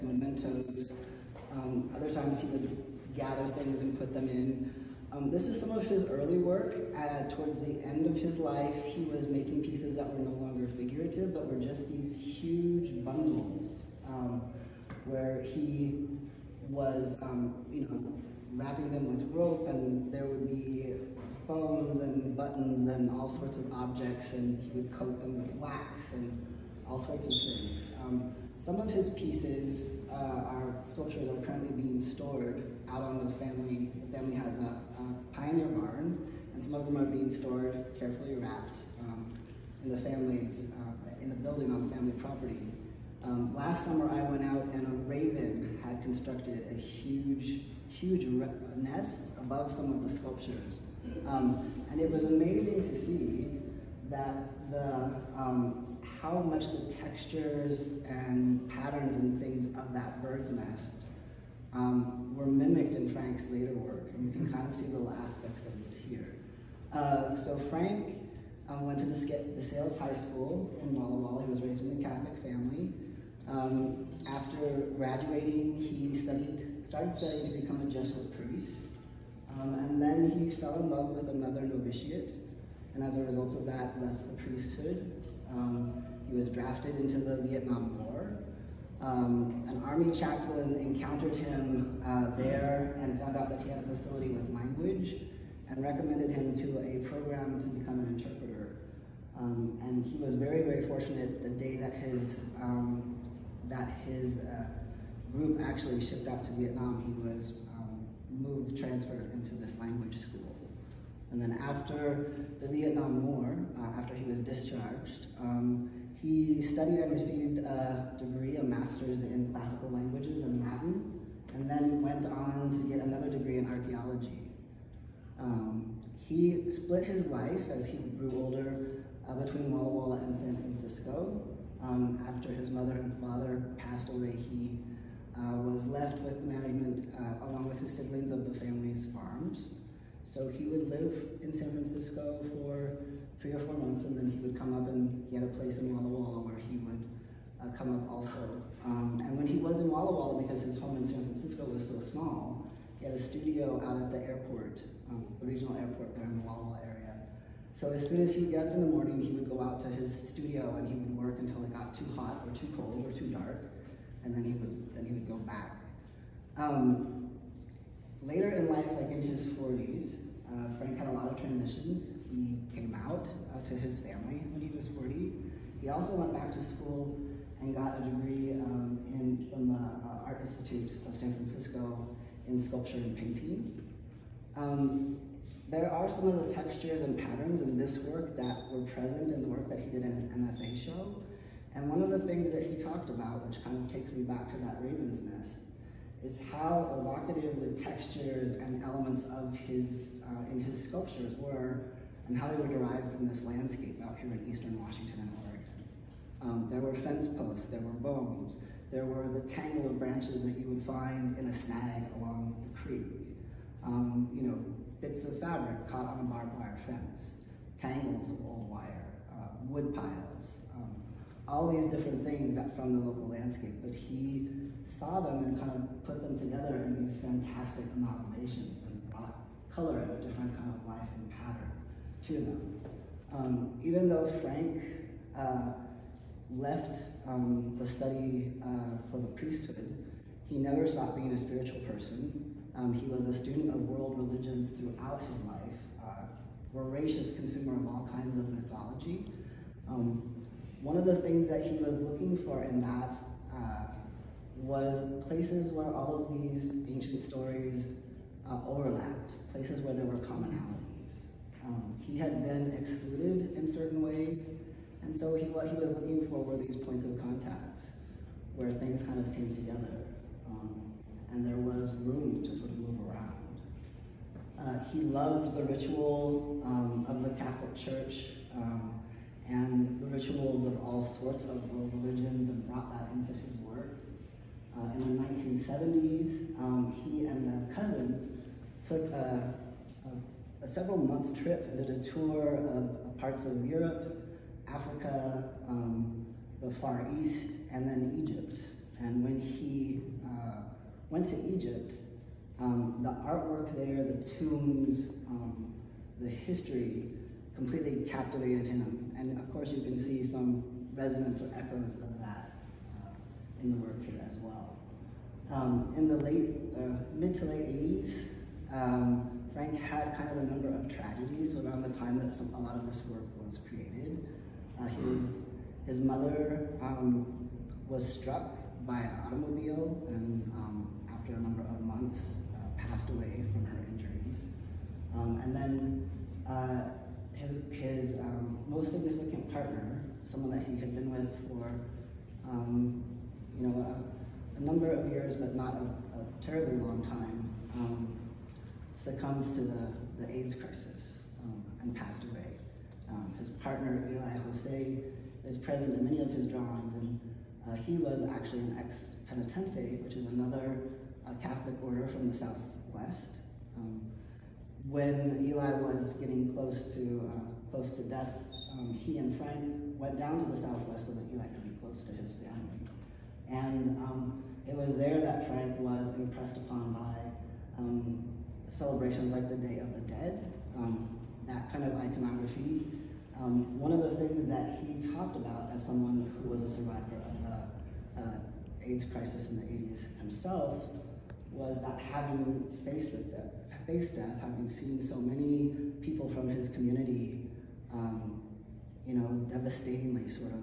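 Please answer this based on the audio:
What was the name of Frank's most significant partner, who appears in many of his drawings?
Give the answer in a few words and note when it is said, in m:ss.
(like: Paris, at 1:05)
Eli Jose, at 5:54.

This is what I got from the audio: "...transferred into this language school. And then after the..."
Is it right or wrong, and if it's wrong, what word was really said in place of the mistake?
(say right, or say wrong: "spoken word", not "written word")
right.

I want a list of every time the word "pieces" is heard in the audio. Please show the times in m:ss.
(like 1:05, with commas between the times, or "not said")
0:09, 0:29.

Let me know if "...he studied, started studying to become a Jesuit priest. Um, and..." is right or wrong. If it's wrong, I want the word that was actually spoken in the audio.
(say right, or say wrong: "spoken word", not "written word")
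right.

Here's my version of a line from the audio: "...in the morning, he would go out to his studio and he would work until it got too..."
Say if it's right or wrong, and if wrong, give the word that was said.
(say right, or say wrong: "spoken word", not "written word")
right.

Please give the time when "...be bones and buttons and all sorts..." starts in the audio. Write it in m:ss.
0:20.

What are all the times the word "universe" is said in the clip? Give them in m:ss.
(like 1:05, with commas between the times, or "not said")
not said.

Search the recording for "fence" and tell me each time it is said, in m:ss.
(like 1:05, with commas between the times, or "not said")
3:26, 3:36.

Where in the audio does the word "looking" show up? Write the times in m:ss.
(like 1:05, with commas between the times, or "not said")
4:11, 4:25.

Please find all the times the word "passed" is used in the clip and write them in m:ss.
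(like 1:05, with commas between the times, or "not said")
2:13, 5:32, 5:51.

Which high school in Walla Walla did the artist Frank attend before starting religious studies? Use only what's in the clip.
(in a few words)
DeSales High School.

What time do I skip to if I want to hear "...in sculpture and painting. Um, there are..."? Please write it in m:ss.
3:02.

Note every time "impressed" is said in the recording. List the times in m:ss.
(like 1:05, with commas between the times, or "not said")
6:16.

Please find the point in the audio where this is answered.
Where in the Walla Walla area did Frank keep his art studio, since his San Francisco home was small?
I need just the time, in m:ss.
2:34.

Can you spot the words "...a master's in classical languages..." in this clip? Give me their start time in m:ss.
1:58.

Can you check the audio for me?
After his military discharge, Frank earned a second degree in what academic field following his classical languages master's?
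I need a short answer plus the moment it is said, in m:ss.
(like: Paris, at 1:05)
Archaeology, at 2:03.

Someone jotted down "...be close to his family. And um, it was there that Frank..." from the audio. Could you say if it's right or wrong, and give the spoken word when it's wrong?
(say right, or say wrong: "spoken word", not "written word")
right.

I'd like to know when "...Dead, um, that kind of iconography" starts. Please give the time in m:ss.
6:20.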